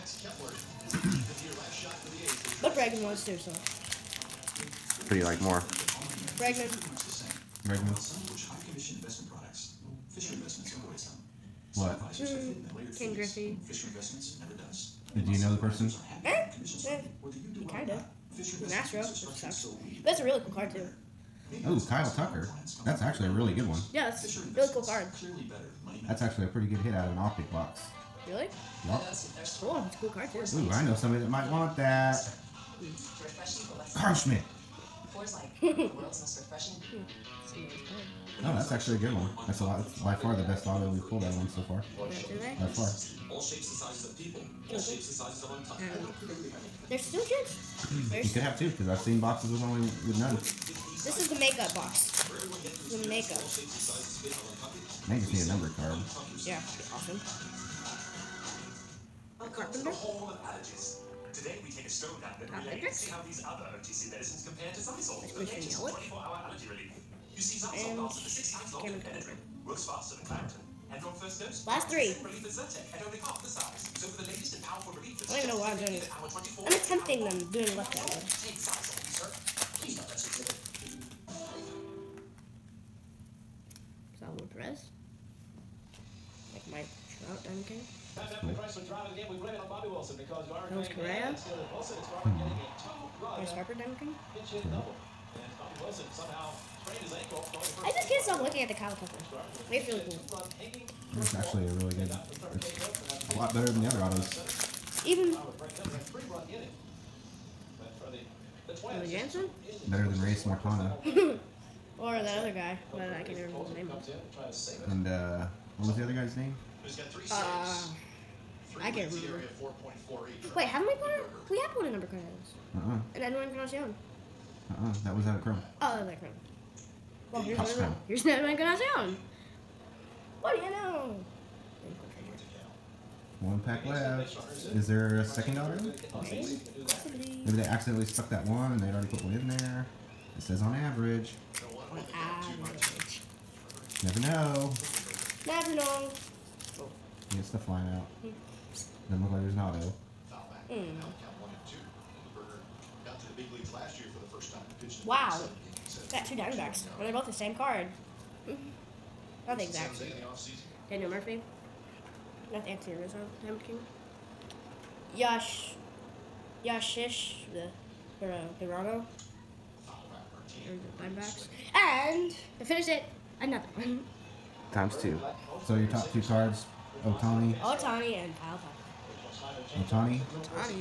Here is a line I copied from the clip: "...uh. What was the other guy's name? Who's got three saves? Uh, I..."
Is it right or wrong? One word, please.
right.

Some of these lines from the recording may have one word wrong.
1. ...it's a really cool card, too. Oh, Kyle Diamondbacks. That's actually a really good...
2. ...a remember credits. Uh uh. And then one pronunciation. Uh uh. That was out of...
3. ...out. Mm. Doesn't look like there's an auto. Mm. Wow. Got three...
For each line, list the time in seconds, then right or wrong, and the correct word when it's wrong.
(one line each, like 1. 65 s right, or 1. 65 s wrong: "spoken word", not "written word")
1. 20 s wrong: "Tucker", not "Diamondbacks"
2. 121 s wrong: "number", not "remember"
3. 147 s wrong: "two", not "three".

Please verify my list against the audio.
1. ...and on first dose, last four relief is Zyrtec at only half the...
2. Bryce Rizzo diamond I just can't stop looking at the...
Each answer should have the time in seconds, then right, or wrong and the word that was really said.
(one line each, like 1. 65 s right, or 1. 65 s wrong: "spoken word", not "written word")
1. 70 s wrong: "three", not "four"
2. 93 s wrong: "Harper", not "Rizzo".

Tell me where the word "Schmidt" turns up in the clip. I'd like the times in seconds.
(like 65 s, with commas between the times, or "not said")
34 s.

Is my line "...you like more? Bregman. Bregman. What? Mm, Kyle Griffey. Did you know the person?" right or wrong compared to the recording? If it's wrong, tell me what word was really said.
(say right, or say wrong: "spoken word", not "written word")
wrong: "Ken", not "Kyle".